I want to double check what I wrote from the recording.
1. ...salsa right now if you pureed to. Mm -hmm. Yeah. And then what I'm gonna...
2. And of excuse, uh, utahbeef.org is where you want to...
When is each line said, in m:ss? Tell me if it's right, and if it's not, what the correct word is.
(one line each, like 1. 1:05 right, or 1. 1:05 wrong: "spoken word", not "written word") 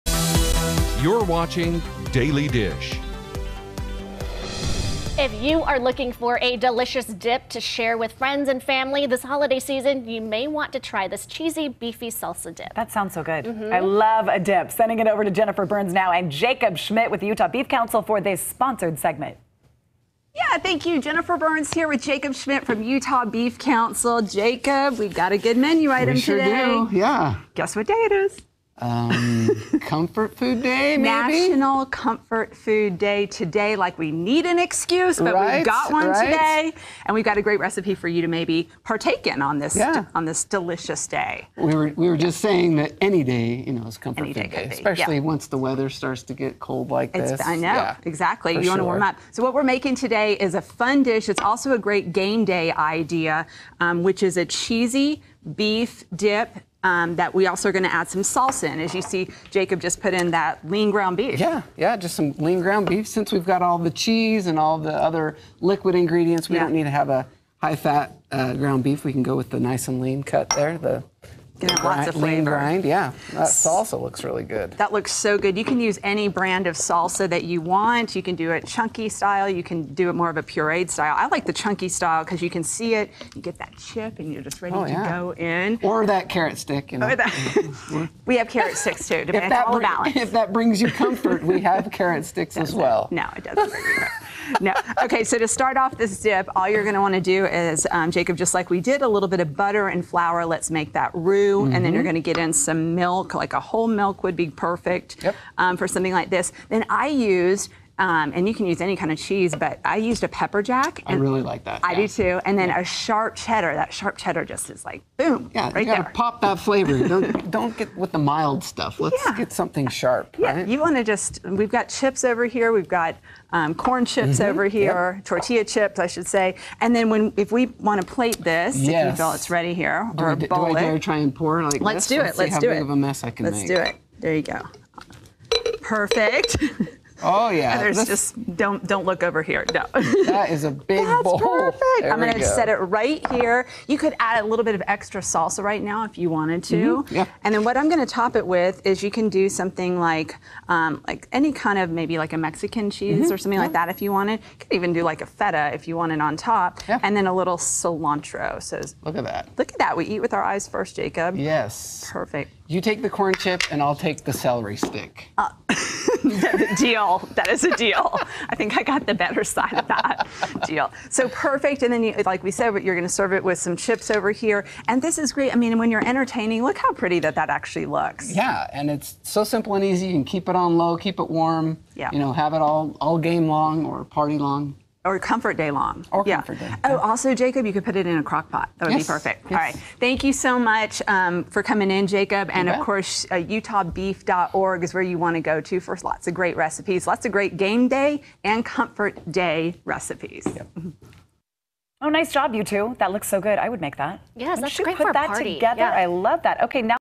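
1. 2:25 wrong: "wanted", not "pureed"
2. 3:12 wrong: "course", not "excuse".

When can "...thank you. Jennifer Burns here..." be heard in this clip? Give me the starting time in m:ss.
0:20.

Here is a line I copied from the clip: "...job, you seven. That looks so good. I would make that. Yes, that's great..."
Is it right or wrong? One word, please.
wrong.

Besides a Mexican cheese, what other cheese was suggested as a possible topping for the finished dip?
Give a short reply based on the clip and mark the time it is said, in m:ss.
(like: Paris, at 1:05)
Feta, at 2:35.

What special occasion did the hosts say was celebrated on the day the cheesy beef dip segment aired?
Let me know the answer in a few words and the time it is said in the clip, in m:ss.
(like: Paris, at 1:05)
National Comfort Food Day, at 0:31.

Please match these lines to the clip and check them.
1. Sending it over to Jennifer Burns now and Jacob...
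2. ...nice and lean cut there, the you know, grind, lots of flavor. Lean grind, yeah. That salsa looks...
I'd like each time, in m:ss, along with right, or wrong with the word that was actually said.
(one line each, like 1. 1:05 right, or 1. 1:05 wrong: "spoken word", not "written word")
1. 0:14 right
2. 1:09 right.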